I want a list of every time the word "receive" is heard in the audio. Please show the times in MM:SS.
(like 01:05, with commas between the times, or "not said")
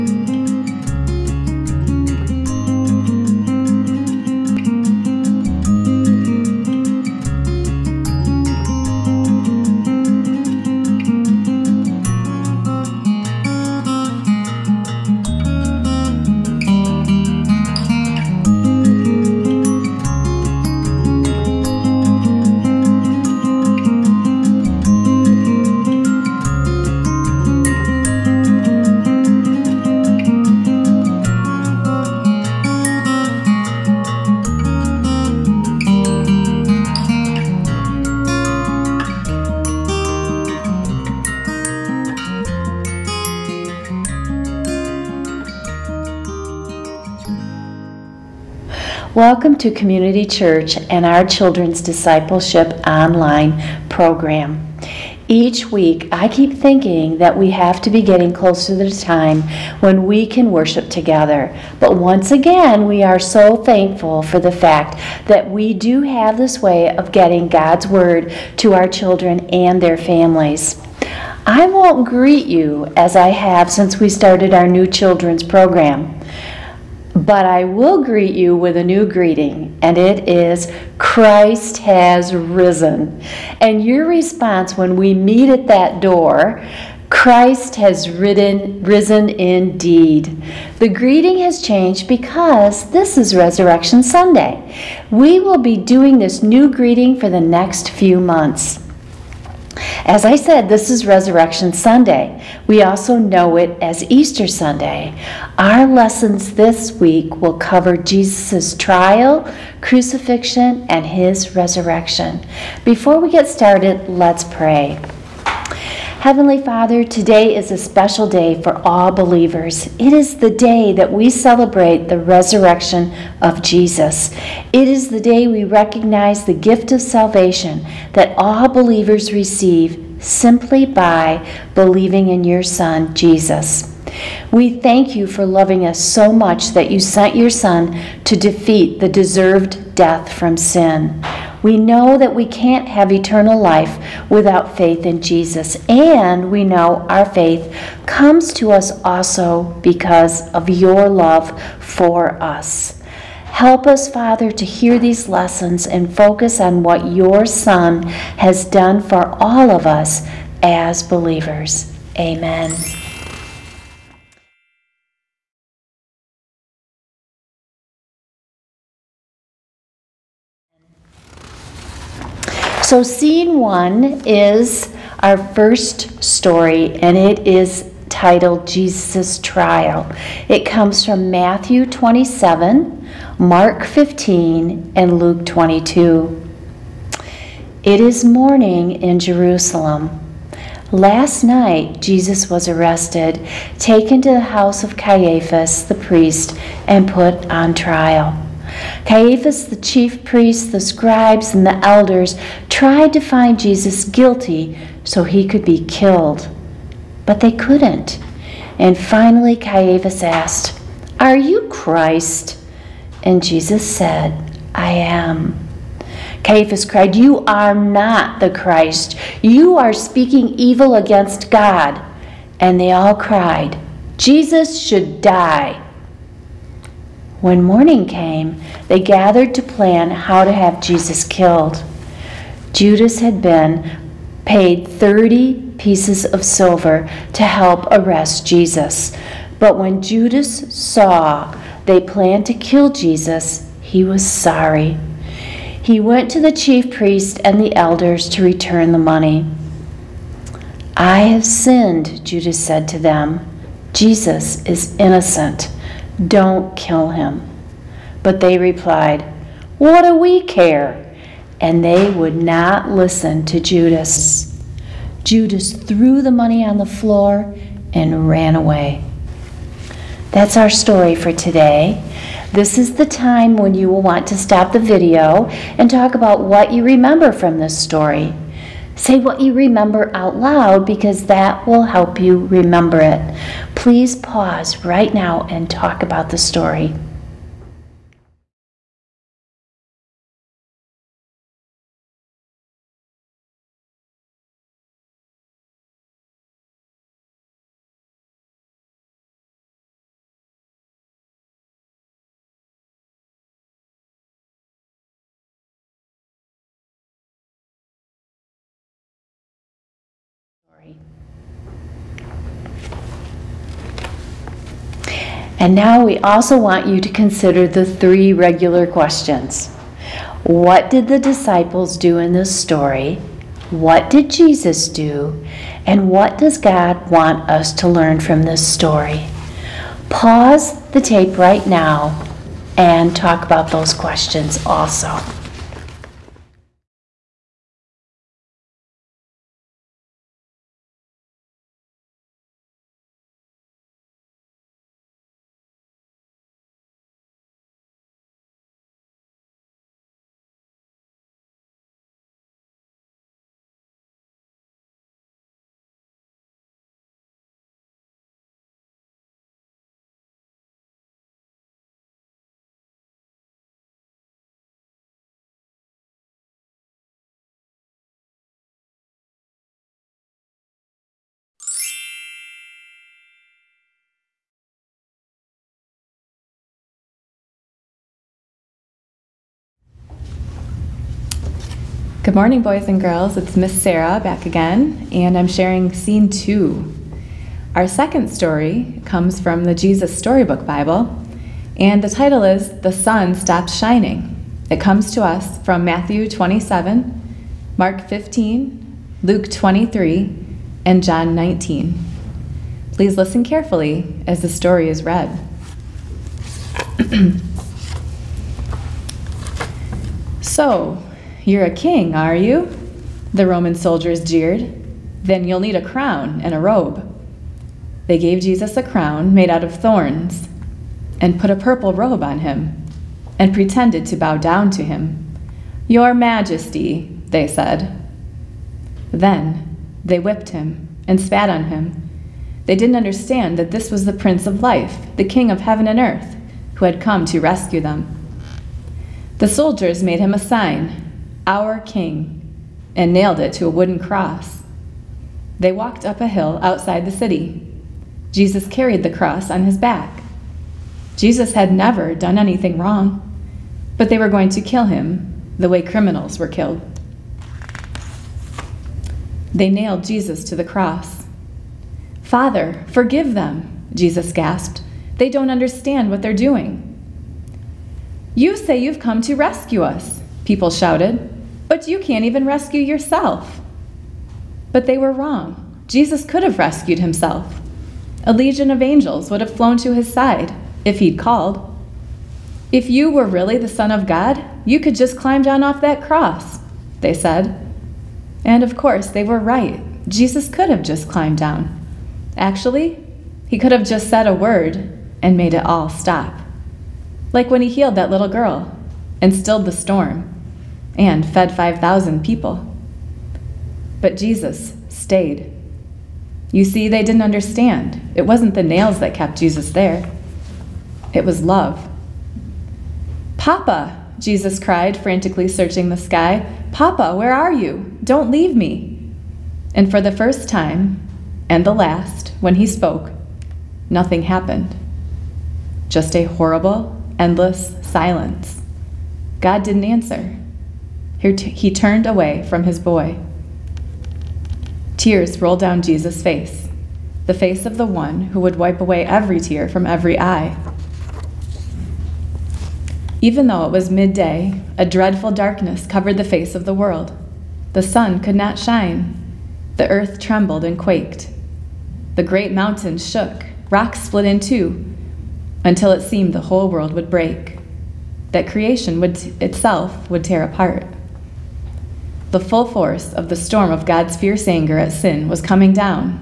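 02:09.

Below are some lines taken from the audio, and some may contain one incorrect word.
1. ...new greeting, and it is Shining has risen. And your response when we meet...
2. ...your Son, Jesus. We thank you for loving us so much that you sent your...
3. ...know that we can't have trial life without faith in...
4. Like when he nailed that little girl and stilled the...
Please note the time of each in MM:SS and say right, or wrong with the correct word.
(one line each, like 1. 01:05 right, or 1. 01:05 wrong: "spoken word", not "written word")
1. 01:18 wrong: "Christ", not "Shining"
2. 02:12 right
3. 02:21 wrong: "eternal", not "trial"
4. 08:17 wrong: "healed", not "nailed".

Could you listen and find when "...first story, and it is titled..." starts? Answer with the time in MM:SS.
02:55.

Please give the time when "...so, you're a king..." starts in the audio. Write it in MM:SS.
06:50.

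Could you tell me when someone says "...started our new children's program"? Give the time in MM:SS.
01:14.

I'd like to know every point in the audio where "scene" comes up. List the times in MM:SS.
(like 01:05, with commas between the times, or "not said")
02:53, 06:25.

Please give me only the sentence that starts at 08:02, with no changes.
If you were really the Son of God, you could just climb down off that cross, they said.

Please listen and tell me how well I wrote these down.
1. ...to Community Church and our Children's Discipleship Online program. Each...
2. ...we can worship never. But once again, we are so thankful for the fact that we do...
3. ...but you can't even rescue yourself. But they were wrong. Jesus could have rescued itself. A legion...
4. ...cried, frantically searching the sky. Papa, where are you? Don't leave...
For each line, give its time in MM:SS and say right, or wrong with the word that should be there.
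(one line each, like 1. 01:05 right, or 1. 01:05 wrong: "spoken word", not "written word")
1. 00:49 right
2. 01:00 wrong: "together", not "never"
3. 07:51 wrong: "himself", not "itself"
4. 08:34 right.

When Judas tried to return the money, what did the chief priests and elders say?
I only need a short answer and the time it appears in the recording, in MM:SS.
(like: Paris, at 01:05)
What do we care?, at 04:19.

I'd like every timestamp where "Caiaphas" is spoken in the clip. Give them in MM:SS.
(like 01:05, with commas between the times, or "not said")
03:14, 03:19, 03:29, 03:36.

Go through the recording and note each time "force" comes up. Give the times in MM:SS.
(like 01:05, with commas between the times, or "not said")
09:22.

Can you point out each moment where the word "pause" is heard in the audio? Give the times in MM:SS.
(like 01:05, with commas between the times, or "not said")
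04:44, 05:30.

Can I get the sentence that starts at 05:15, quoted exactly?
And now we also want you to consider the three regular questions What did the disciples do in this story?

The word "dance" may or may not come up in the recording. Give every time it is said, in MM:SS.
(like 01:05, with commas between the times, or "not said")
not said.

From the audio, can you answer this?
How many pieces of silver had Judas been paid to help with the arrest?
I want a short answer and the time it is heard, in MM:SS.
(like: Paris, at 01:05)
30, at 03:54.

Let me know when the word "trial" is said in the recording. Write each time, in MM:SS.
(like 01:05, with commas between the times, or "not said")
01:48, 02:59, 03:17.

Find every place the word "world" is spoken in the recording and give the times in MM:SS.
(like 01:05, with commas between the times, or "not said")
09:06, 09:16.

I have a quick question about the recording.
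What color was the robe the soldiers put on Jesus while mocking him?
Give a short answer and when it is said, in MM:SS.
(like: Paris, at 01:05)
Purple, at 07:01.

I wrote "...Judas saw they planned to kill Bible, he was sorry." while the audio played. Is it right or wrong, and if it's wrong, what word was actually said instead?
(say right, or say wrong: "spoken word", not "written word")
wrong: "Jesus", not "Bible".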